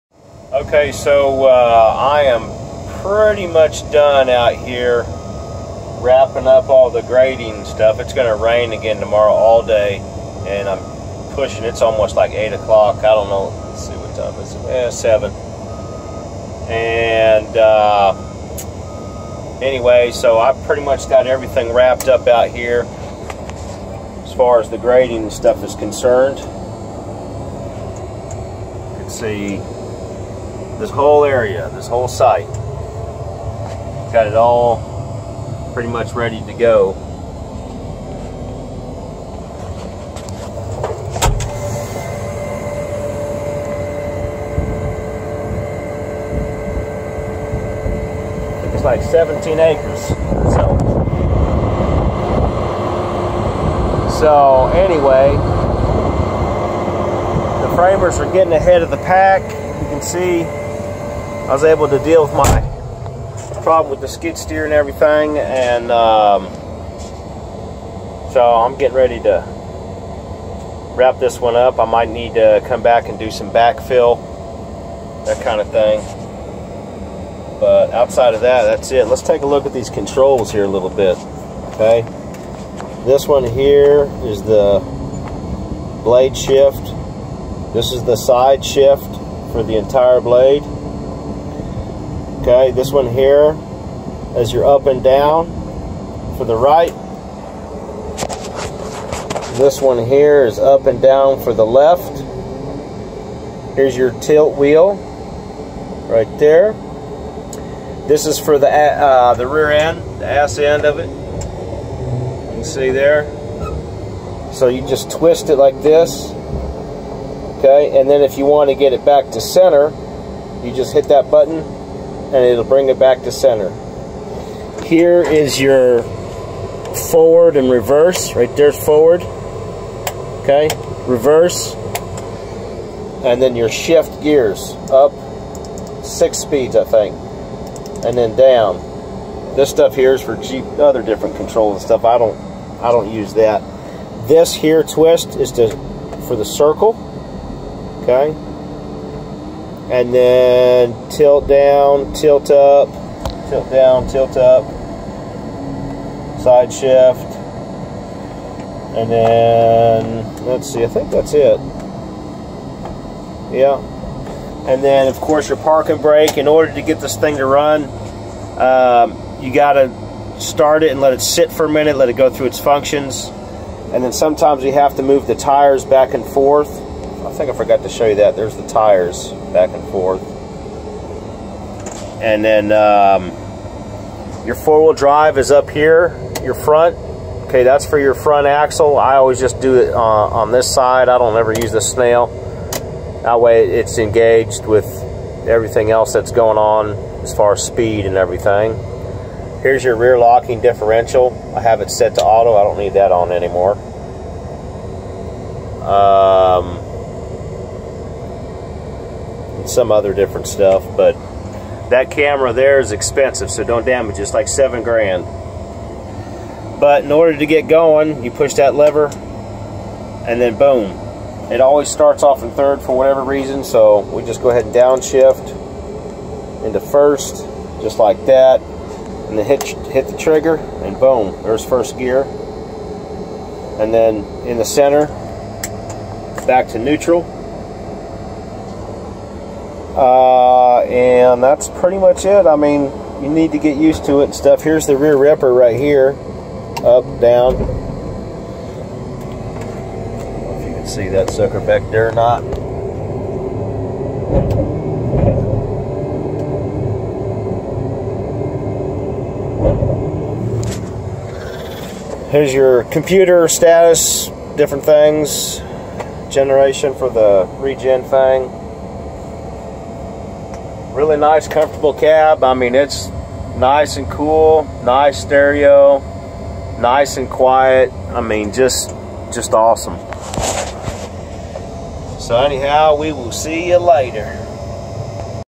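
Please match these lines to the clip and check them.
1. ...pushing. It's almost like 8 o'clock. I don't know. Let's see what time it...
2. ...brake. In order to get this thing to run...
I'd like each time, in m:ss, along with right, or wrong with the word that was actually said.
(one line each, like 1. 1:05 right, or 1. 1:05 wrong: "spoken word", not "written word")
1. 0:11 right
2. 2:46 right.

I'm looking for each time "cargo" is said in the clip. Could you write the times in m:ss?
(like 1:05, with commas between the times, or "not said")
not said.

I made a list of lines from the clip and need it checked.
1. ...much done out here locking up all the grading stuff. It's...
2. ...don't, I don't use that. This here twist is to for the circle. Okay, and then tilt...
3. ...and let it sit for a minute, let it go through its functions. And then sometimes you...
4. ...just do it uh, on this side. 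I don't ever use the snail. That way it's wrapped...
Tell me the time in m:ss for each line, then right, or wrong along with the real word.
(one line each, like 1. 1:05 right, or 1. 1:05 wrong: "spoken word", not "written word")
1. 0:03 wrong: "wrapping", not "locking"
2. 2:22 right
3. 2:50 right
4. 3:09 wrong: "engaged", not "wrapped".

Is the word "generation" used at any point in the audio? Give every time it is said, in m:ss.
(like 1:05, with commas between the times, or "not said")
4:26.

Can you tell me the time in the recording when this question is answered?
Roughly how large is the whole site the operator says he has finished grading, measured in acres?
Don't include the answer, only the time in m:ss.
0:49.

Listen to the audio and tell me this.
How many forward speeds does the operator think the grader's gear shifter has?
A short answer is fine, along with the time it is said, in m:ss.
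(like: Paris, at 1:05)
6, at 2:16.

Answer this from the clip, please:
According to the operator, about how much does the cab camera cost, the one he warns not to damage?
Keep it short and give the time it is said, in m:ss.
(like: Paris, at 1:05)
7 grand, at 3:34.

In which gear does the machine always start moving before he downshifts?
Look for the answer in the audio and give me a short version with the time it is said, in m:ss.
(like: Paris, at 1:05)
third, at 3:42.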